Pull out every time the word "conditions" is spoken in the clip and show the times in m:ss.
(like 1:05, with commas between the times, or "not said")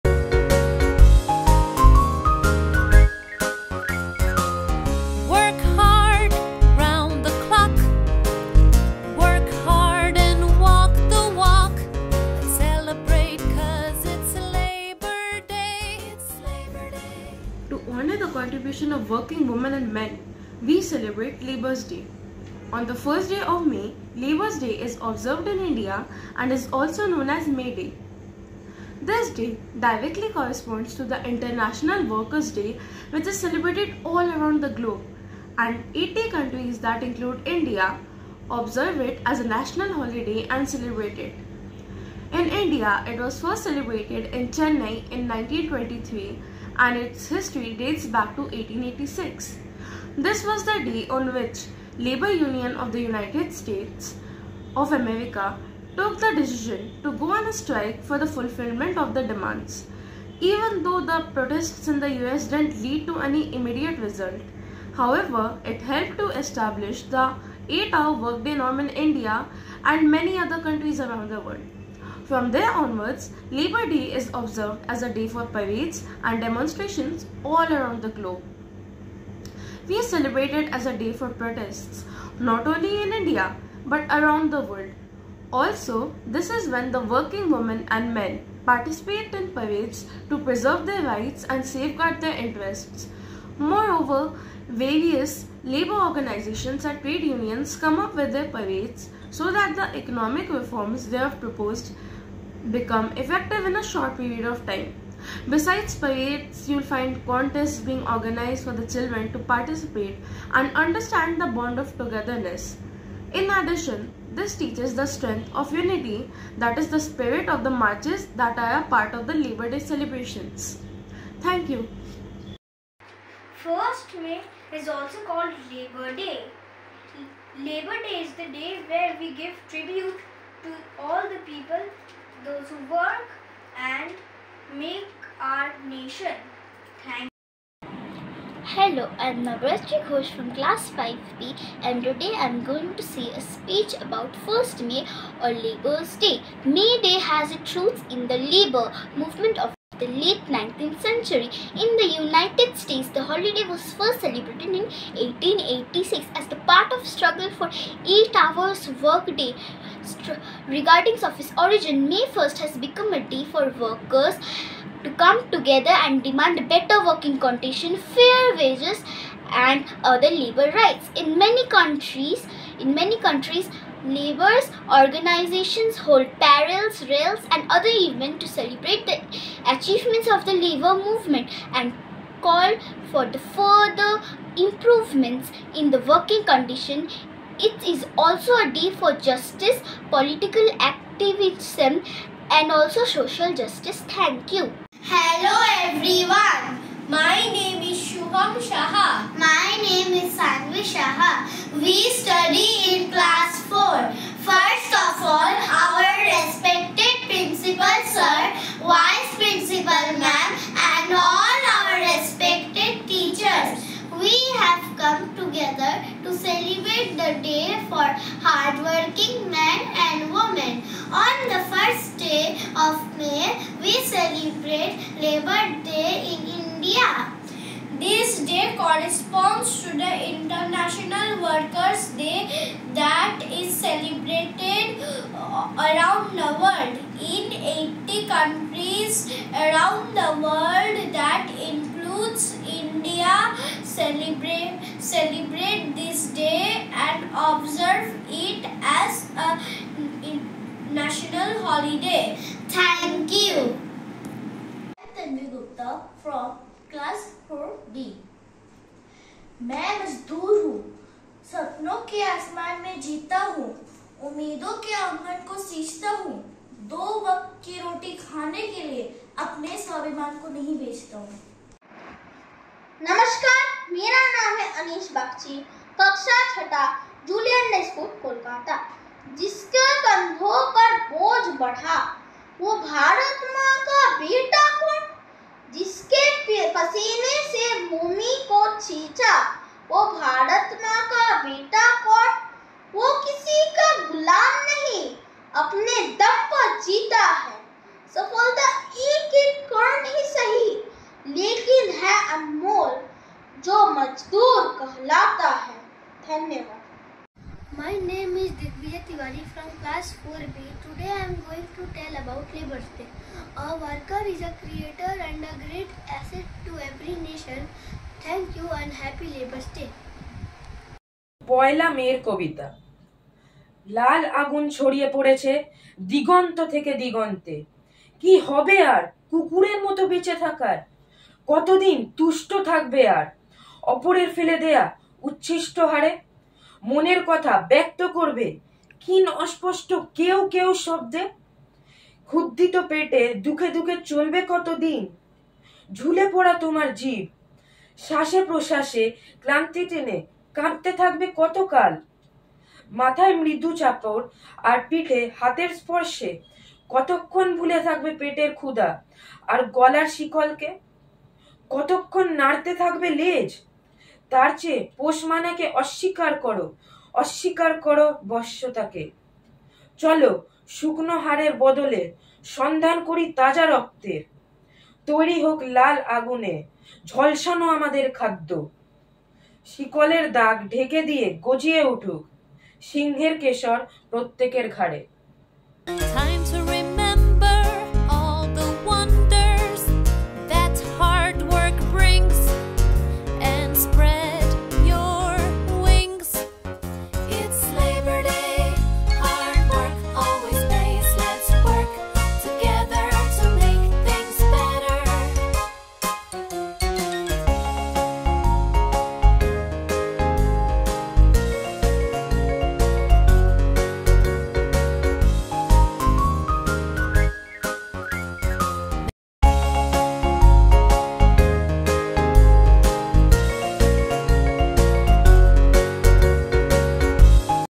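2:47, 3:06.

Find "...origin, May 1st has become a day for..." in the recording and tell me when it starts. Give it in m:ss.
2:41.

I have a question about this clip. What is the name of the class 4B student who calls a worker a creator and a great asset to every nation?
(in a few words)
Digvijay Tiwari.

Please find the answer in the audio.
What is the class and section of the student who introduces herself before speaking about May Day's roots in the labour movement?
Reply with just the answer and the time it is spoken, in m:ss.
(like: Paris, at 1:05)
5B, at 2:20.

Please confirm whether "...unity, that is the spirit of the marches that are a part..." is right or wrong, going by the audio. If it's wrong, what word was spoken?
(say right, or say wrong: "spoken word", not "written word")
right.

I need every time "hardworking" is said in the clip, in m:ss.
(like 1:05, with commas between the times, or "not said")
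3:38.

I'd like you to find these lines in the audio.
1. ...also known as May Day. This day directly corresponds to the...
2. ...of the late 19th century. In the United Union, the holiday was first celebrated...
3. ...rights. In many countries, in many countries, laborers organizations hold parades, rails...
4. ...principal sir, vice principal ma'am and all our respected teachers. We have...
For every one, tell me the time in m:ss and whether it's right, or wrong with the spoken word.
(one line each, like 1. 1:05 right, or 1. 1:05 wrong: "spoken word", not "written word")
1. 0:26 right
2. 2:29 wrong: "States", not "Union"
3. 2:50 right
4. 3:27 right.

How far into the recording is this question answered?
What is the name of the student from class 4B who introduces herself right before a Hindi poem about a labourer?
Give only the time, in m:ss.
4:15.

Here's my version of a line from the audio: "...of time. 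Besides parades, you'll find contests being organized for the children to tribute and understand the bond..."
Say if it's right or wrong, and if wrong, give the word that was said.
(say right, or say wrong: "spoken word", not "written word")
wrong: "participate", not "tribute".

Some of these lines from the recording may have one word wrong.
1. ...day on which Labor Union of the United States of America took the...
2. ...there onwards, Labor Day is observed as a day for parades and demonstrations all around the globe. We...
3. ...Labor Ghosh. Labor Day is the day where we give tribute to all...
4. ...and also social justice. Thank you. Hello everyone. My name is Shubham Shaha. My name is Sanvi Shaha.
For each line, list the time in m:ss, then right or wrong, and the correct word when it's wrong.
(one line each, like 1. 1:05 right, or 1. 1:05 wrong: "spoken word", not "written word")
1. 0:50 right
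2. 1:12 right
3. 2:05 wrong: "Day", not "Ghosh"
4. 3:12 right.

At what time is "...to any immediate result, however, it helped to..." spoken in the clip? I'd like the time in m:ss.
1:03.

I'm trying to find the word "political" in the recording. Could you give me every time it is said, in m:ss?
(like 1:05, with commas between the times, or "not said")
3:10.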